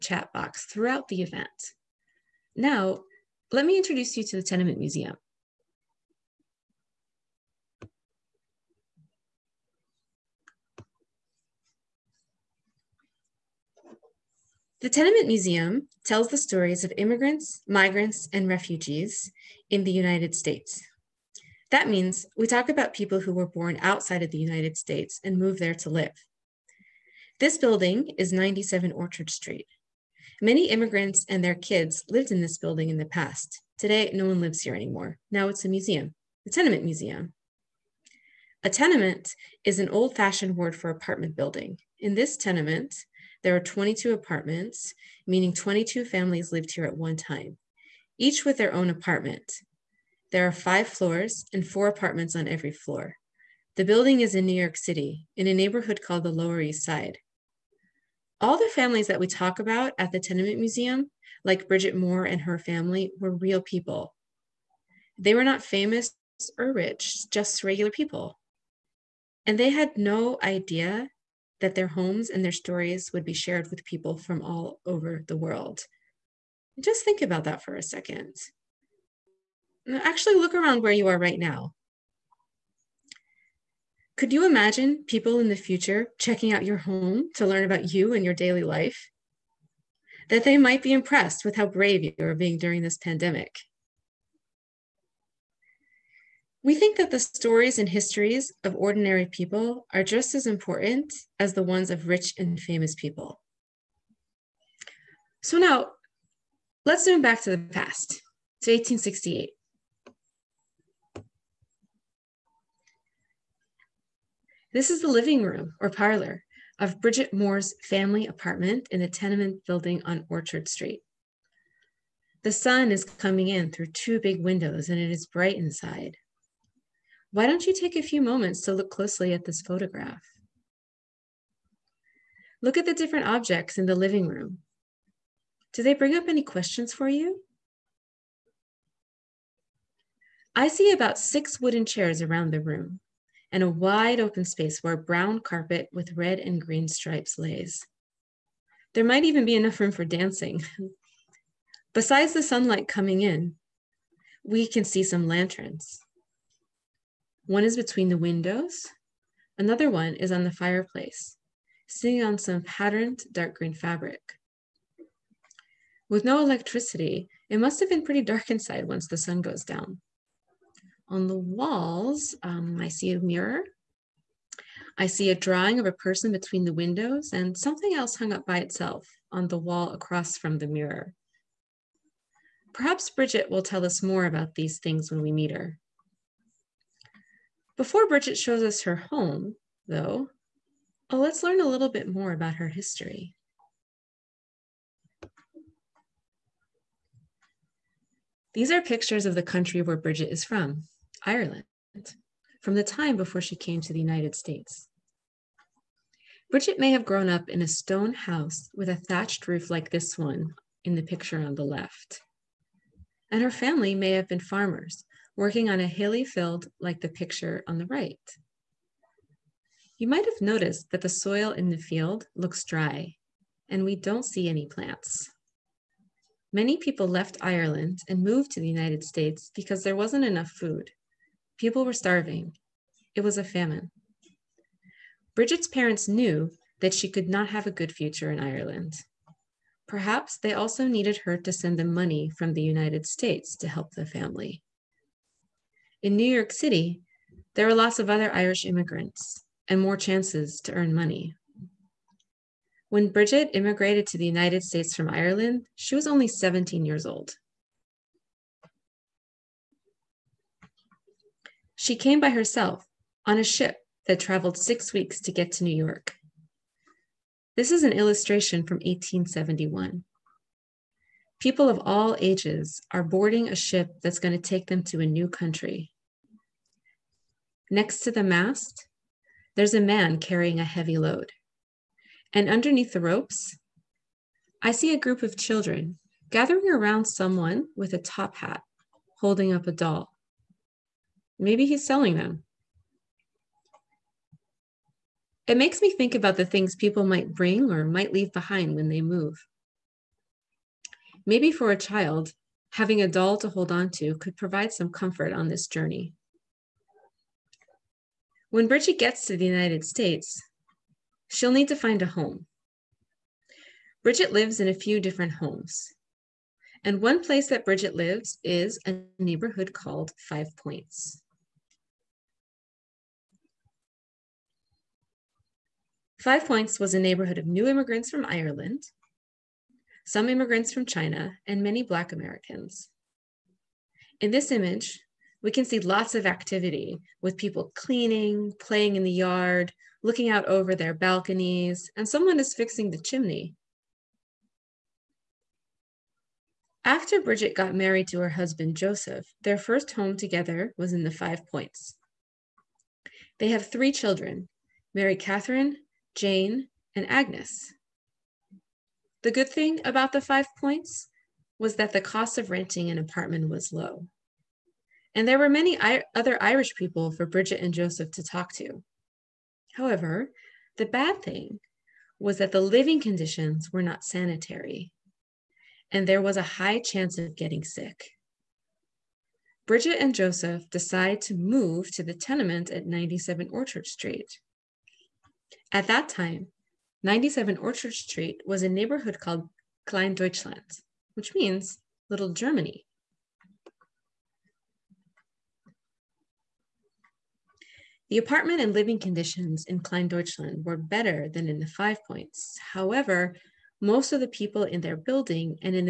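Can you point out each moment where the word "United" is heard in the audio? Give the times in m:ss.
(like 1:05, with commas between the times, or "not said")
0:19, 0:24, 3:23, 3:48, 4:02, 4:14, 5:09.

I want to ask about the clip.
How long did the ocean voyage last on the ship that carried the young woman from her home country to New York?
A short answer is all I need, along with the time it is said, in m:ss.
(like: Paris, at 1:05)
six weeks, at 4:24.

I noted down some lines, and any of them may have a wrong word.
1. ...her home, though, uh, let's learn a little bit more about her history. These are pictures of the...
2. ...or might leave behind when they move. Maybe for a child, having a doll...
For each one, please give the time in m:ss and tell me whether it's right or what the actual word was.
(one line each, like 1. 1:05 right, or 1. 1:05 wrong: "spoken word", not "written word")
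1. 3:08 right
2. 4:57 right.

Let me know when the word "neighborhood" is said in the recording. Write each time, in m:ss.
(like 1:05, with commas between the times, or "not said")
0:55, 5:19, 5:26, 6:28.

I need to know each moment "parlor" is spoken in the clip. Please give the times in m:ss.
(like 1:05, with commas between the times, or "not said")
1:55.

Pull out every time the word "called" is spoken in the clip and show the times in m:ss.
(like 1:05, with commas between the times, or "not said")
0:55, 5:19, 6:29.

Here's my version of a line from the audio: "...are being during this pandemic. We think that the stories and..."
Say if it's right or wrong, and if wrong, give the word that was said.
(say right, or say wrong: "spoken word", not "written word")
right.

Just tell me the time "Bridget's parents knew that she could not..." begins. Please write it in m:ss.
3:55.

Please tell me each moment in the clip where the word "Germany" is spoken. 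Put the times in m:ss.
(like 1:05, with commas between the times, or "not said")
6:32.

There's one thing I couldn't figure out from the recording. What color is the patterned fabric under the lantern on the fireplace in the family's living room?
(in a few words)
dark green.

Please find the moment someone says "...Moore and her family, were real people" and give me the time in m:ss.
1:01.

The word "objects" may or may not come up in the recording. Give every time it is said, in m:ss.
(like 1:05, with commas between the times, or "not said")
2:13.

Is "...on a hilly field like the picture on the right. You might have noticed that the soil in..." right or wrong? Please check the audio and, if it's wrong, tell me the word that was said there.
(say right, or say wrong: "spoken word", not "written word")
right.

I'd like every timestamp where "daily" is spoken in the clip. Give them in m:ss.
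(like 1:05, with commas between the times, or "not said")
1:28.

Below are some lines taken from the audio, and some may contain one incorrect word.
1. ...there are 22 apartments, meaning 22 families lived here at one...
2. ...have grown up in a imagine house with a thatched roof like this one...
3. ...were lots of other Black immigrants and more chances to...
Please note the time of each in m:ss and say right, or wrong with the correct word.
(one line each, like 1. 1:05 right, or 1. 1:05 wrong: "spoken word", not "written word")
1. 0:43 right
2. 3:26 wrong: "stone", not "imagine"
3. 4:07 wrong: "Irish", not "Black".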